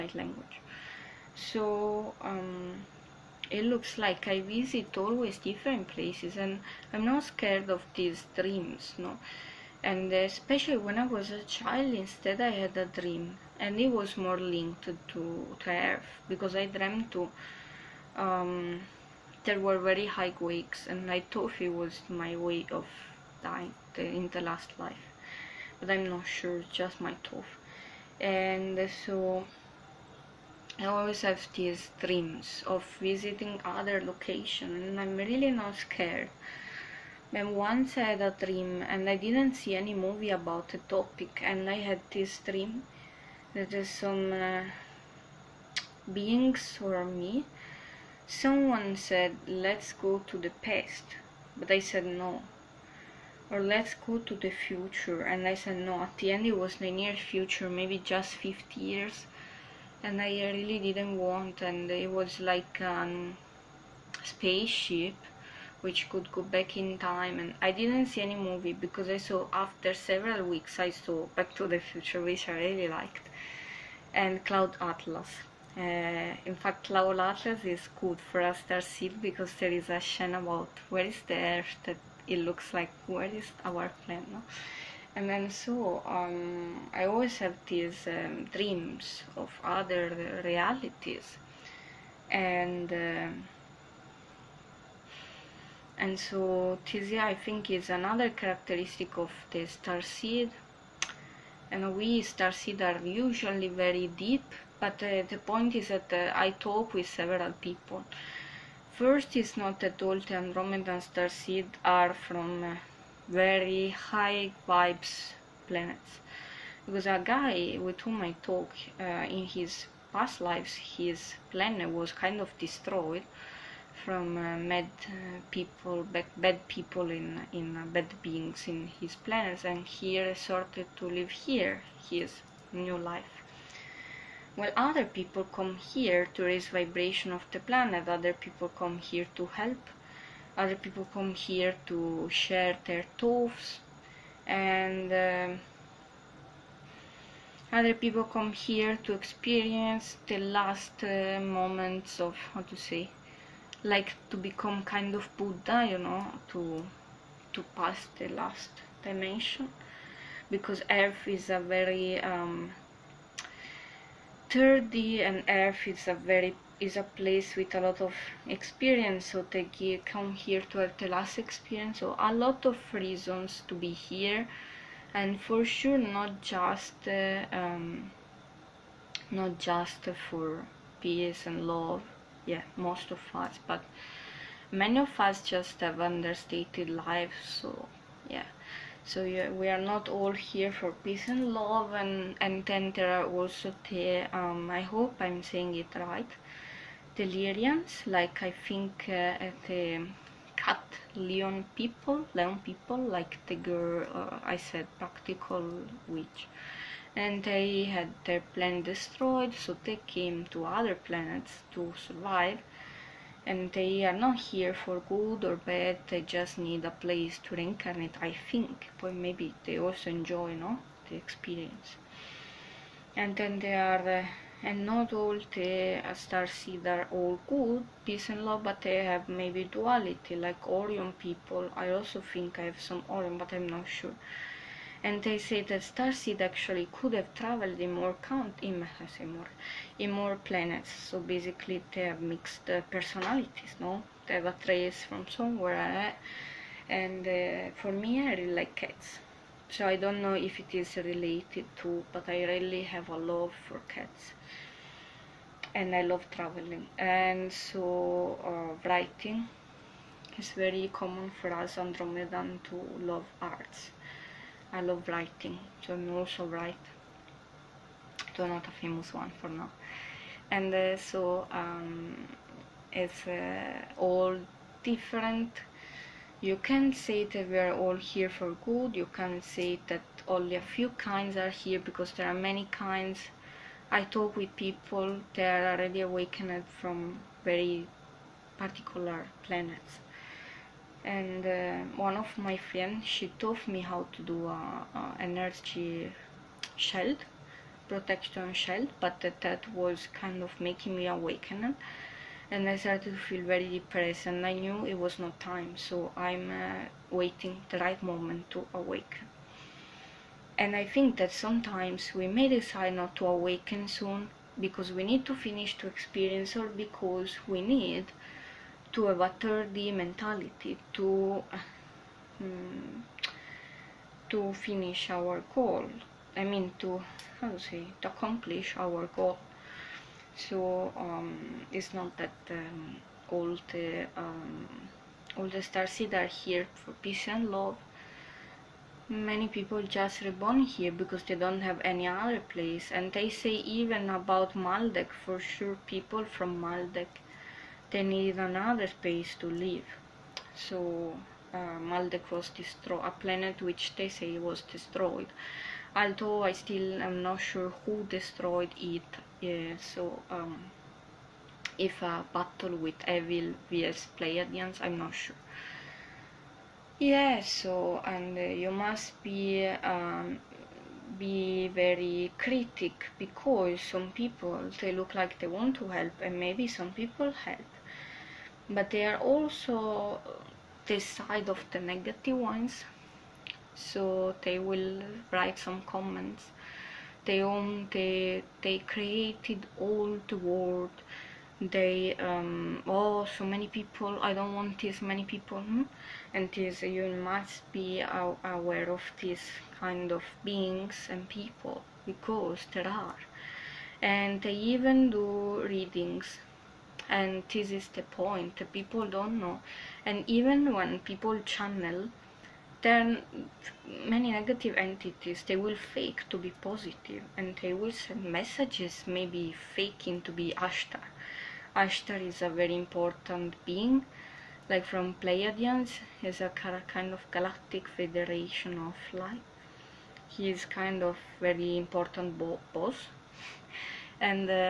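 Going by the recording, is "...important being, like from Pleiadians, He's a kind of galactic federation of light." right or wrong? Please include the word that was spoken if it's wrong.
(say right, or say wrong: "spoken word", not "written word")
right.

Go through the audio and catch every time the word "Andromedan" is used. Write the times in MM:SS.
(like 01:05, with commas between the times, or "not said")
01:50, 04:21.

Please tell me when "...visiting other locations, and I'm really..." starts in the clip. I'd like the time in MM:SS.
00:32.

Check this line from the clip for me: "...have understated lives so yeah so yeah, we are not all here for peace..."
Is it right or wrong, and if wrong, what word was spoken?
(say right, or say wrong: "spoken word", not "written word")
right.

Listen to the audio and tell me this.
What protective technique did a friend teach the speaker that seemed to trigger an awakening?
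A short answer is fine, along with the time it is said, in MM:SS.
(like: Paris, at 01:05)
energy shield, at 04:55.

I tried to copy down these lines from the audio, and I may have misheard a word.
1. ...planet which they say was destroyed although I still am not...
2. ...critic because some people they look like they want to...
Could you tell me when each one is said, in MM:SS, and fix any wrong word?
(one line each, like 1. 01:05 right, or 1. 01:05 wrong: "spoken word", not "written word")
1. 05:53 right
2. 06:12 right.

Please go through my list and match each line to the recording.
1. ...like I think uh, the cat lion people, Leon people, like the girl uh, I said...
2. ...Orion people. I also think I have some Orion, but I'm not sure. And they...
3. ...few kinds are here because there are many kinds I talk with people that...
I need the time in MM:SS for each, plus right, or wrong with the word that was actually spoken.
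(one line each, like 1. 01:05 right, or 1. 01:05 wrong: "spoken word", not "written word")
1. 03:18 right
2. 03:50 right
3. 04:40 right.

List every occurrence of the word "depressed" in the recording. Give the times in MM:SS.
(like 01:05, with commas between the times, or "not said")
05:03.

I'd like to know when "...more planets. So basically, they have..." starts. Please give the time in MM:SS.
04:00.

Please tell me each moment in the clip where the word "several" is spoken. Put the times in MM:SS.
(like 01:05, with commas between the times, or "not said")
01:09, 01:47.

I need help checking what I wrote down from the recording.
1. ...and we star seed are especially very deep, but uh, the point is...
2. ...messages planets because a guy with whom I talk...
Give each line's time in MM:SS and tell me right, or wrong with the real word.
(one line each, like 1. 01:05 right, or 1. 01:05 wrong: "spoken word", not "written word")
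1. 01:41 wrong: "usually", not "especially"
2. 01:54 wrong: "vibes", not "messages".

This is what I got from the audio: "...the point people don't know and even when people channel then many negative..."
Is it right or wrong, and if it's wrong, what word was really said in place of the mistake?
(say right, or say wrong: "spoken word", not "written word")
right.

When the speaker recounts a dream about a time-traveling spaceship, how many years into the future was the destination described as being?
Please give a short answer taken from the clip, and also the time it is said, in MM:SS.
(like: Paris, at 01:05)
50, at 00:58.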